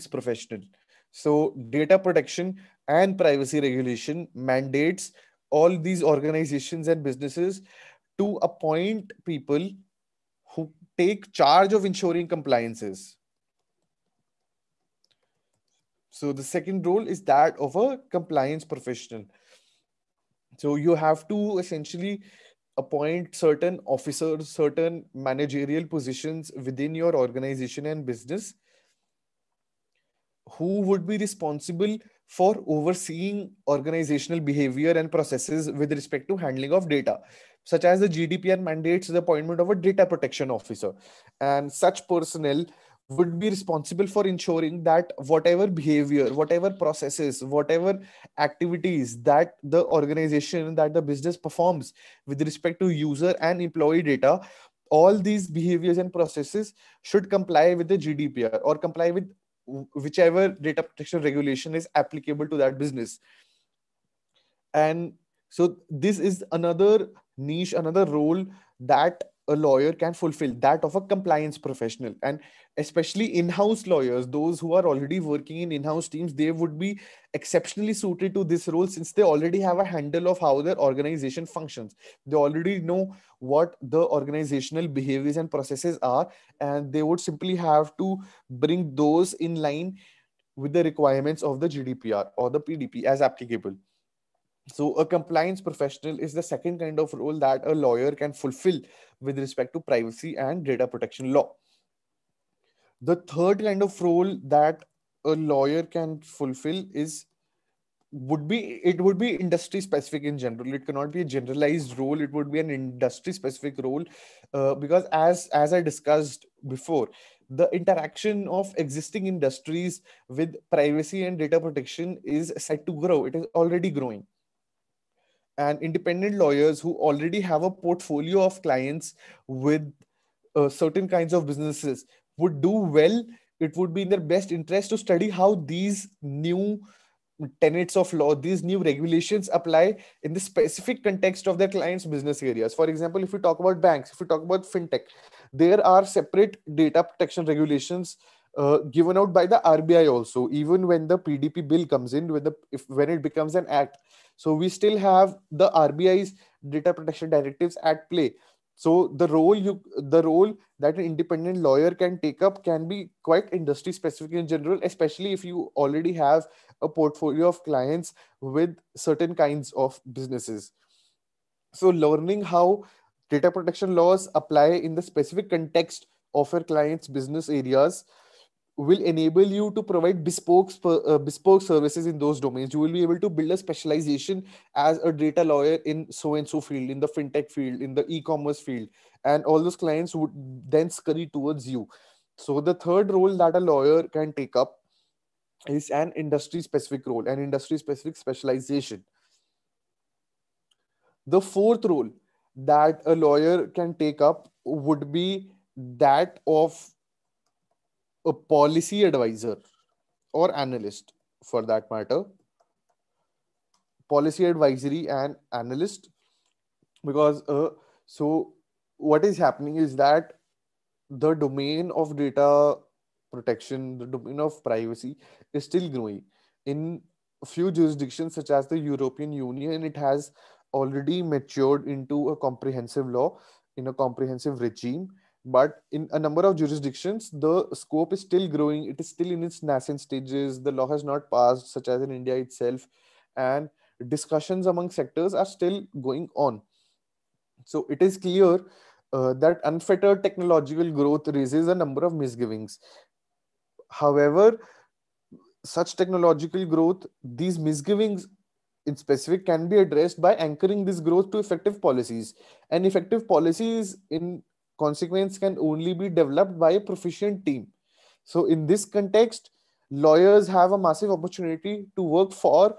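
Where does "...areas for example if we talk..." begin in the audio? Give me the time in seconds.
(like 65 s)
142 s.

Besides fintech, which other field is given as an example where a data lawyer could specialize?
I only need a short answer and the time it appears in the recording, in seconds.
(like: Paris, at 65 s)
E-commerce, at 188 s.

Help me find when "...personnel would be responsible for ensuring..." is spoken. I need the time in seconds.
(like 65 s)
42 s.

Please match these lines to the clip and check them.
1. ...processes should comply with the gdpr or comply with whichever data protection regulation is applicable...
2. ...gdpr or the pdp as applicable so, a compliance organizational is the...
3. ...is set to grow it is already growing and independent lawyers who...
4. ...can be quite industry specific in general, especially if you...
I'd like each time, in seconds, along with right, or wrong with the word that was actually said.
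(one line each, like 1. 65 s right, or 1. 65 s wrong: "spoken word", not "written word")
1. 56 s right
2. 91 s wrong: "professional", not "organizational"
3. 122 s right
4. 162 s right.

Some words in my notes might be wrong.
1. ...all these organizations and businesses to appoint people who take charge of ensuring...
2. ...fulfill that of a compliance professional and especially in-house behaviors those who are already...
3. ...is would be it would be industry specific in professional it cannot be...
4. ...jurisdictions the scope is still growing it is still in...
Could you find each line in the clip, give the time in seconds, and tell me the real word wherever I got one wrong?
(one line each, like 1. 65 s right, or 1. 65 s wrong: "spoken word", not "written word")
1. 5 s right
2. 70 s wrong: "lawyers", not "behaviors"
3. 106 s wrong: "general", not "professional"
4. 236 s right.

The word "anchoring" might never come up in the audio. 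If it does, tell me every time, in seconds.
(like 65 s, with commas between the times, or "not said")
260 s.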